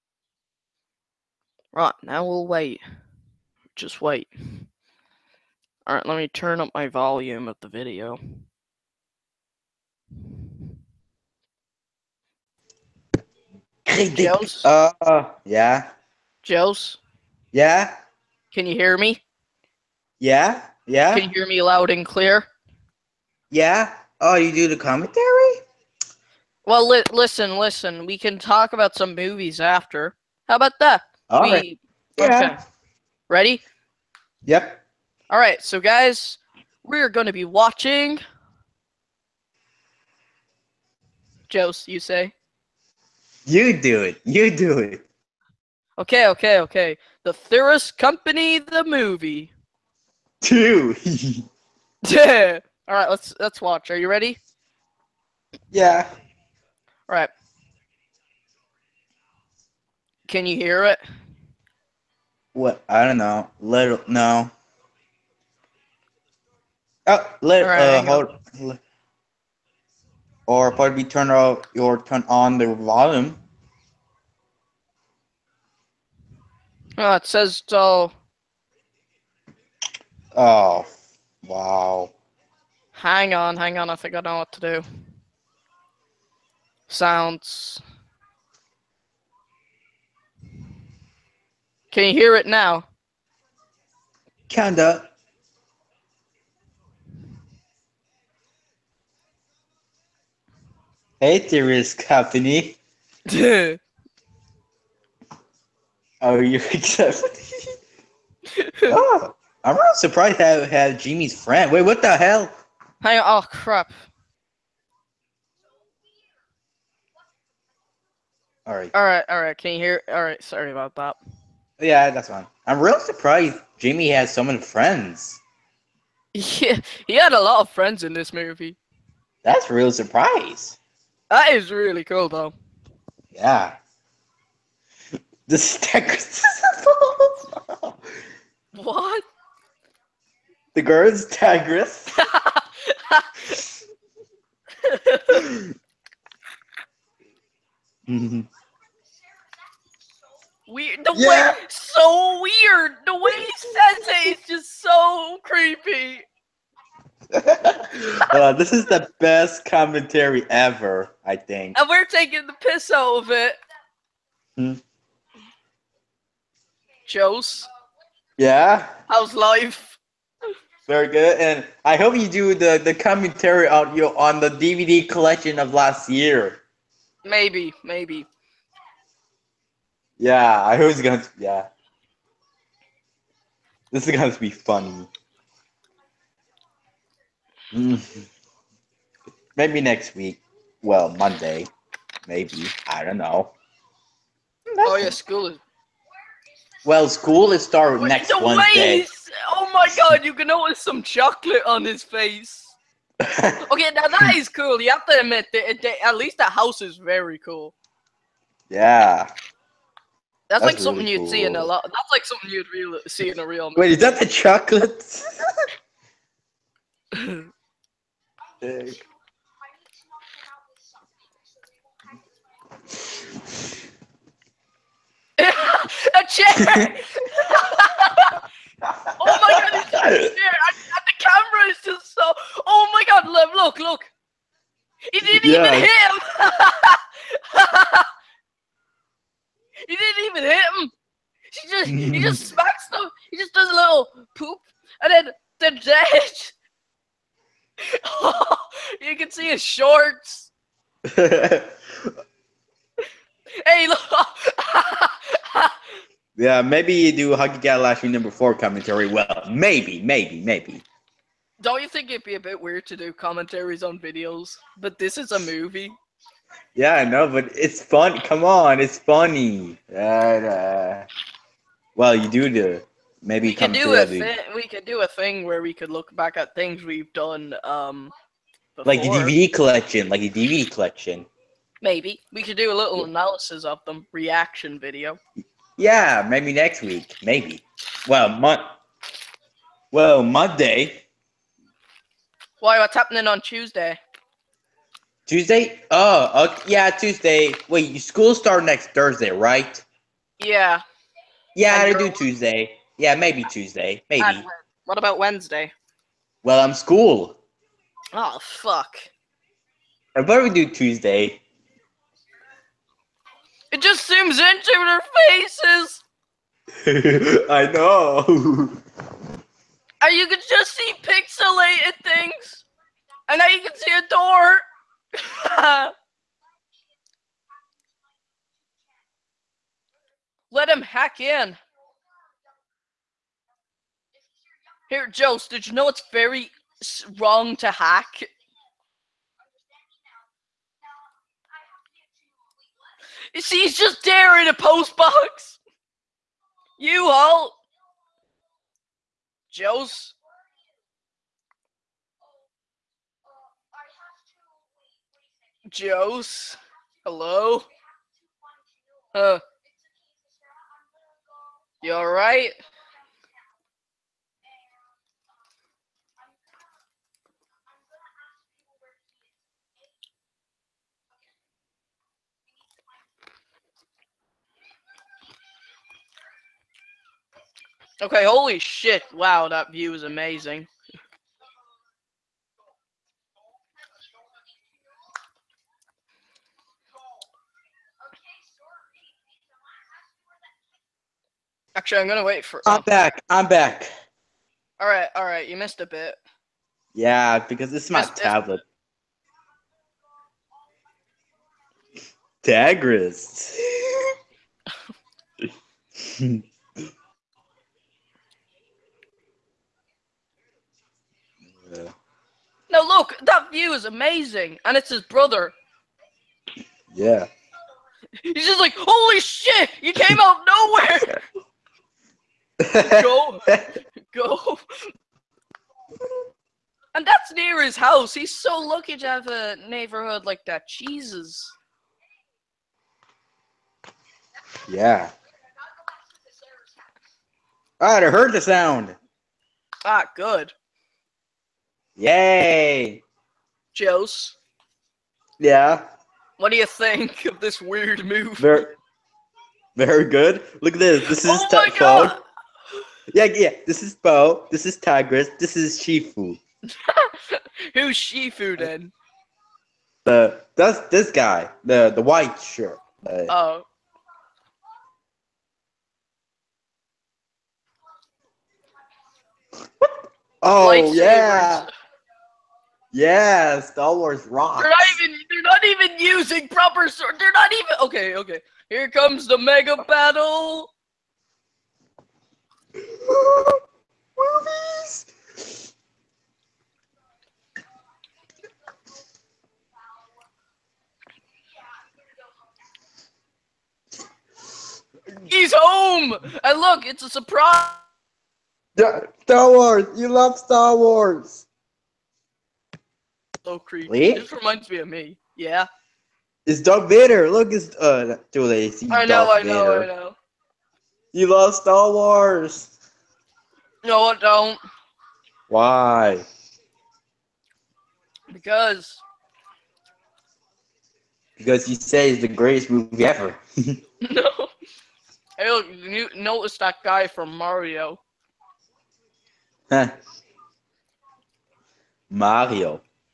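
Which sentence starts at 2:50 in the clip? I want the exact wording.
Very good, and I hope you do the the commentary on your on the DVD collection of last year.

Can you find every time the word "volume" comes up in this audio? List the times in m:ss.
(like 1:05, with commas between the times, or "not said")
0:06, 1:12.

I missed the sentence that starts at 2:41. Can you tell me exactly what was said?
And we're taking the piss out of it.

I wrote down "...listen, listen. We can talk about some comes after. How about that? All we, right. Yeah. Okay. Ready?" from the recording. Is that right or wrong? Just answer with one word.
wrong.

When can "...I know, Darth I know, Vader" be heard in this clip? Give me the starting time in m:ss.
8:28.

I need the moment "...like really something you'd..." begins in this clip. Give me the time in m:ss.
3:30.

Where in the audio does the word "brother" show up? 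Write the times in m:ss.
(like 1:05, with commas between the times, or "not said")
6:55.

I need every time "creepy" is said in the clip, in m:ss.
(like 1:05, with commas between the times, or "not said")
2:35, 8:23.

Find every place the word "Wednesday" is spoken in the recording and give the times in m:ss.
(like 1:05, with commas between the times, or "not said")
3:18, 5:05.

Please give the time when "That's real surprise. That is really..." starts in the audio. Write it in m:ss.
2:09.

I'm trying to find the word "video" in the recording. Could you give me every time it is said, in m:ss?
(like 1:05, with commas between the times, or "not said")
0:07, 4:23, 4:44.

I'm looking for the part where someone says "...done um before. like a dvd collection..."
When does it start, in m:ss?
4:37.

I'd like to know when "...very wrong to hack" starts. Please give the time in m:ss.
5:36.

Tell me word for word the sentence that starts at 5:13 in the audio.
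It just zooms into their faces.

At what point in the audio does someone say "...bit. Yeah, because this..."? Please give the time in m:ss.
6:35.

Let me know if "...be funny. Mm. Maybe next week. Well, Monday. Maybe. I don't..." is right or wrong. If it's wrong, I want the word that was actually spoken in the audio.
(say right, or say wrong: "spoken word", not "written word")
right.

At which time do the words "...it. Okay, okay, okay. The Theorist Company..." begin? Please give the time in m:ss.
0:44.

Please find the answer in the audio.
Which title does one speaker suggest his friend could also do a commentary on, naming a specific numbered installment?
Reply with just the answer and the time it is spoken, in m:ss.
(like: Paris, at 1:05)
Huggy Galaxy number four, at 4:17.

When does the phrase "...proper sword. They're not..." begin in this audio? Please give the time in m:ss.
7:56.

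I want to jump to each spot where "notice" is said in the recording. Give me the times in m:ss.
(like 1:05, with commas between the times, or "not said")
3:20, 8:46.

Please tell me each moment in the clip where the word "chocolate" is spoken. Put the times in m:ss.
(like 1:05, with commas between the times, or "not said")
3:21, 3:34.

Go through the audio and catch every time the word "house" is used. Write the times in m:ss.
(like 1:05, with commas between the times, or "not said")
3:26, 7:07.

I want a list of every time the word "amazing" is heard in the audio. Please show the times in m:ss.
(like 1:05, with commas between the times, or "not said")
6:20, 6:53.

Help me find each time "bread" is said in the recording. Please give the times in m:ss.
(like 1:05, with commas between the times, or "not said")
not said.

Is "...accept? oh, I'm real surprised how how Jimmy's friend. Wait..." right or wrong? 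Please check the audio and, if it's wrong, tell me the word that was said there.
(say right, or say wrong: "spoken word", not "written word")
right.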